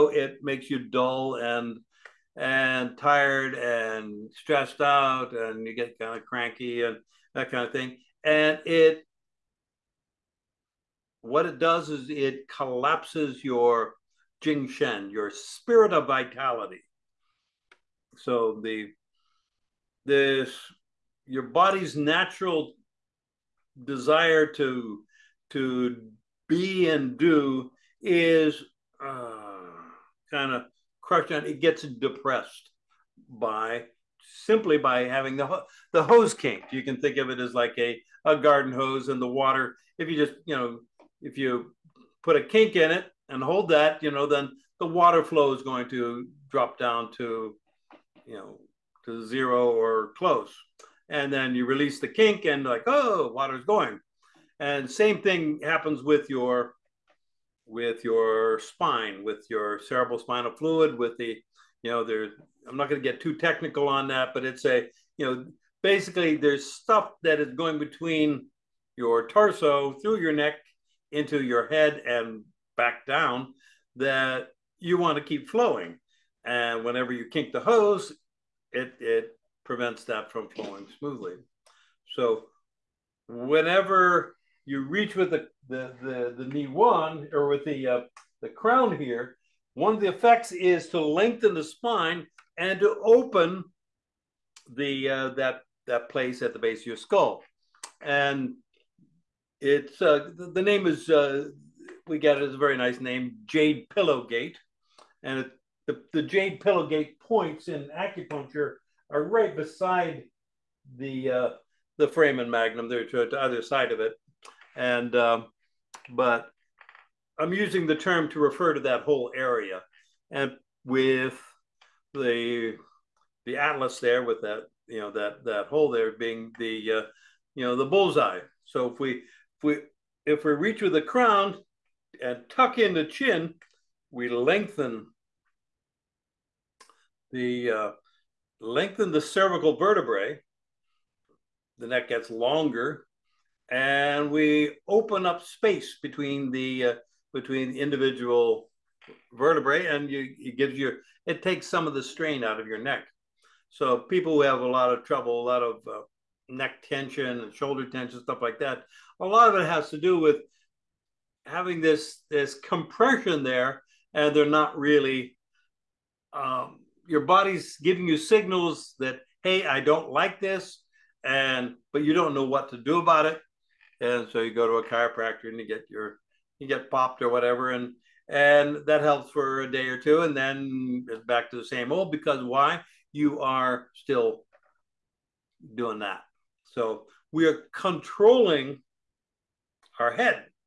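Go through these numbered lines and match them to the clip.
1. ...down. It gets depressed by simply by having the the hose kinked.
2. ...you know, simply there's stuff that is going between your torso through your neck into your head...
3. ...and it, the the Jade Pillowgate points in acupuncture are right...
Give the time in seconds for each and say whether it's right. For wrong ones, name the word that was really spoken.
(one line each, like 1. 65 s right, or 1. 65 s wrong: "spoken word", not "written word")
1. 31 s right
2. 65 s wrong: "basically", not "simply"
3. 105 s right.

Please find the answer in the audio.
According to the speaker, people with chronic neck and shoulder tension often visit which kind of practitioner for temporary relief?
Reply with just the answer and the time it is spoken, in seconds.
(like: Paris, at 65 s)
chiropractor, at 174 s.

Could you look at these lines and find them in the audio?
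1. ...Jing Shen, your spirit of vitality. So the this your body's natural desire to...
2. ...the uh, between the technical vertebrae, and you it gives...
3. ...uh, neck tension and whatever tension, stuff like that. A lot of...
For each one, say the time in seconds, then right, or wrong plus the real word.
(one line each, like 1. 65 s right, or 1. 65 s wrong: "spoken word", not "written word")
1. 14 s right
2. 146 s wrong: "individual", not "technical"
3. 155 s wrong: "shoulder", not "whatever".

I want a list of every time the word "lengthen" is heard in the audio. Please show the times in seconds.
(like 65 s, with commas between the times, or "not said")
90 s, 134 s, 138 s.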